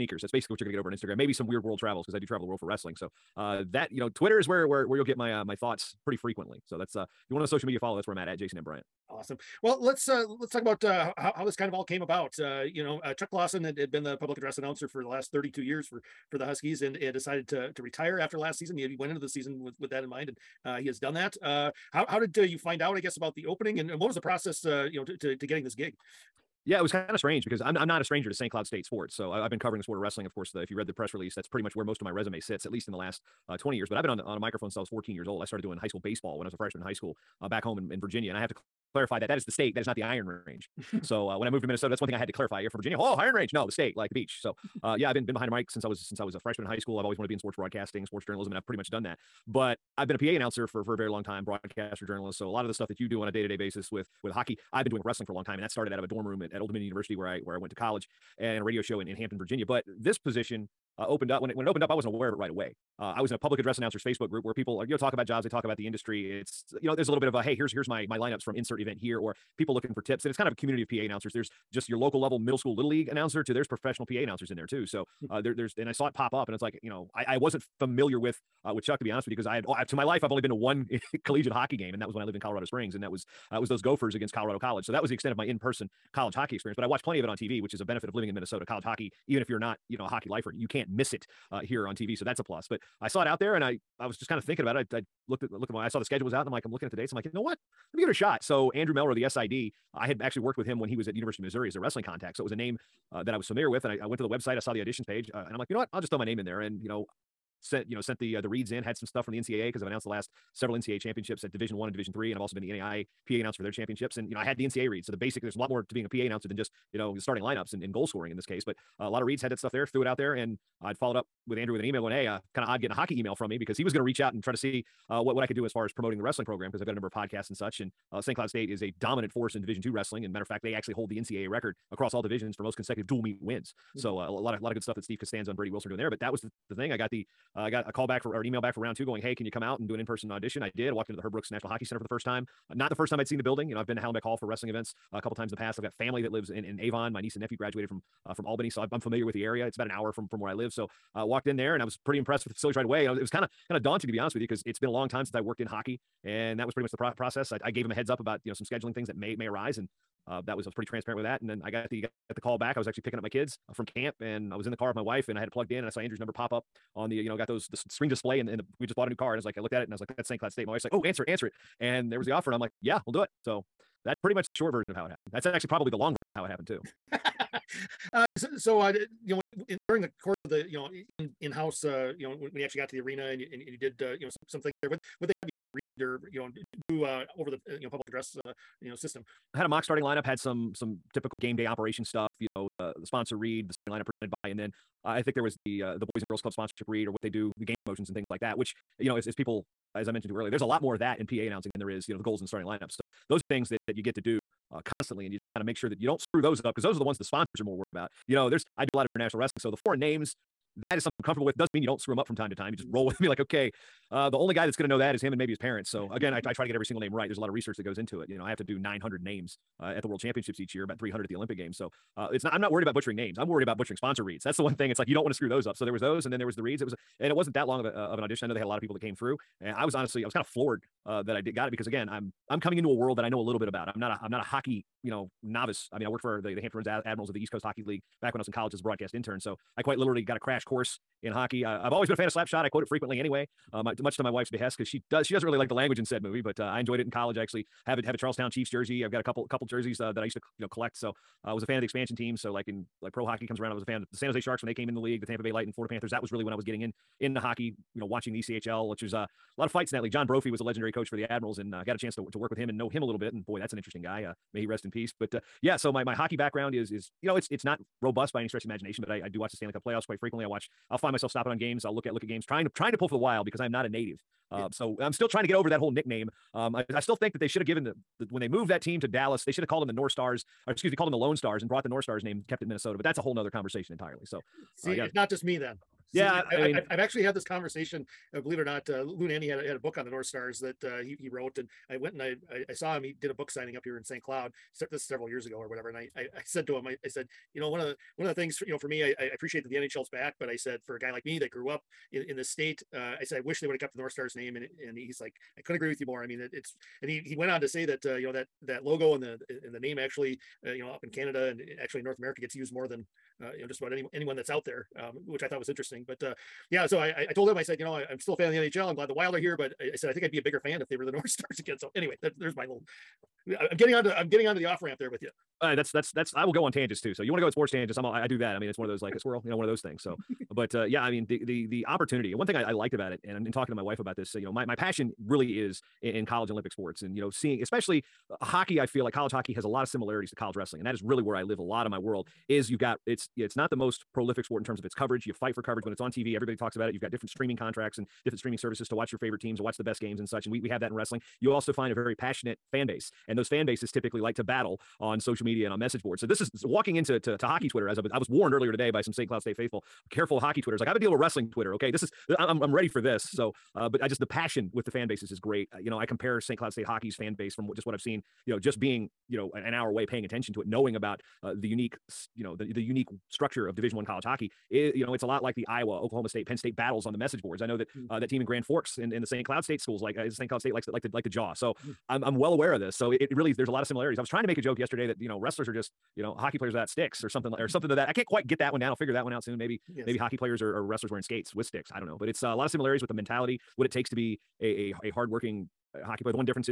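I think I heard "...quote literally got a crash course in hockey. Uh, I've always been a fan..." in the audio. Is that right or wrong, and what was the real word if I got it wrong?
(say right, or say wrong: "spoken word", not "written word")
wrong: "quite", not "quote".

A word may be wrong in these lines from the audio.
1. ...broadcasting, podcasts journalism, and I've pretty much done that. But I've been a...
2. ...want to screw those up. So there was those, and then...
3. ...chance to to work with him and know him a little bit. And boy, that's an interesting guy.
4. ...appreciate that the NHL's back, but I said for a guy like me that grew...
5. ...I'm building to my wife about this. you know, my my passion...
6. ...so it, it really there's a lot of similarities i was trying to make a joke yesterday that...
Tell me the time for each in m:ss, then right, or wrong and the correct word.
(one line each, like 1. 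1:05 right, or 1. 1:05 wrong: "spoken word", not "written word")
1. 0:47 wrong: "sports", not "podcasts"
2. 3:45 right
3. 4:21 right
4. 4:59 right
5. 5:33 wrong: "talking", not "building"
6. 6:22 right.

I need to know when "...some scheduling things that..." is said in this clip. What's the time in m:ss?
2:38.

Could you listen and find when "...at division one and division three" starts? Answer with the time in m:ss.
1:51.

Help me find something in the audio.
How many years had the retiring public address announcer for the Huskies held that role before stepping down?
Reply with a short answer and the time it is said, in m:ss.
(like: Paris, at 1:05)
32, at 0:15.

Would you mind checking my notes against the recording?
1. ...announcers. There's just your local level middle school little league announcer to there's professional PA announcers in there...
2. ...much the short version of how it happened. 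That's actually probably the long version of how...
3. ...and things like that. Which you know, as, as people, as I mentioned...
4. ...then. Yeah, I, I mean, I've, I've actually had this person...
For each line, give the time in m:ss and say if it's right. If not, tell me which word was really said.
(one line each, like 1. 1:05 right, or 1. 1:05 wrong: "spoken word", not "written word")
1. 1:10 right
2. 2:54 right
3. 3:18 right
4. 4:45 wrong: "conversation", not "person".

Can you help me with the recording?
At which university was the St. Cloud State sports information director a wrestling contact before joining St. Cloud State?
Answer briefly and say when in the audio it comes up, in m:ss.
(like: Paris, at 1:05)
University of Missouri, at 1:41.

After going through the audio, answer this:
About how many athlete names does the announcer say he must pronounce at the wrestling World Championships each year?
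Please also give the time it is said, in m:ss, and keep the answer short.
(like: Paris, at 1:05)
900, at 3:38.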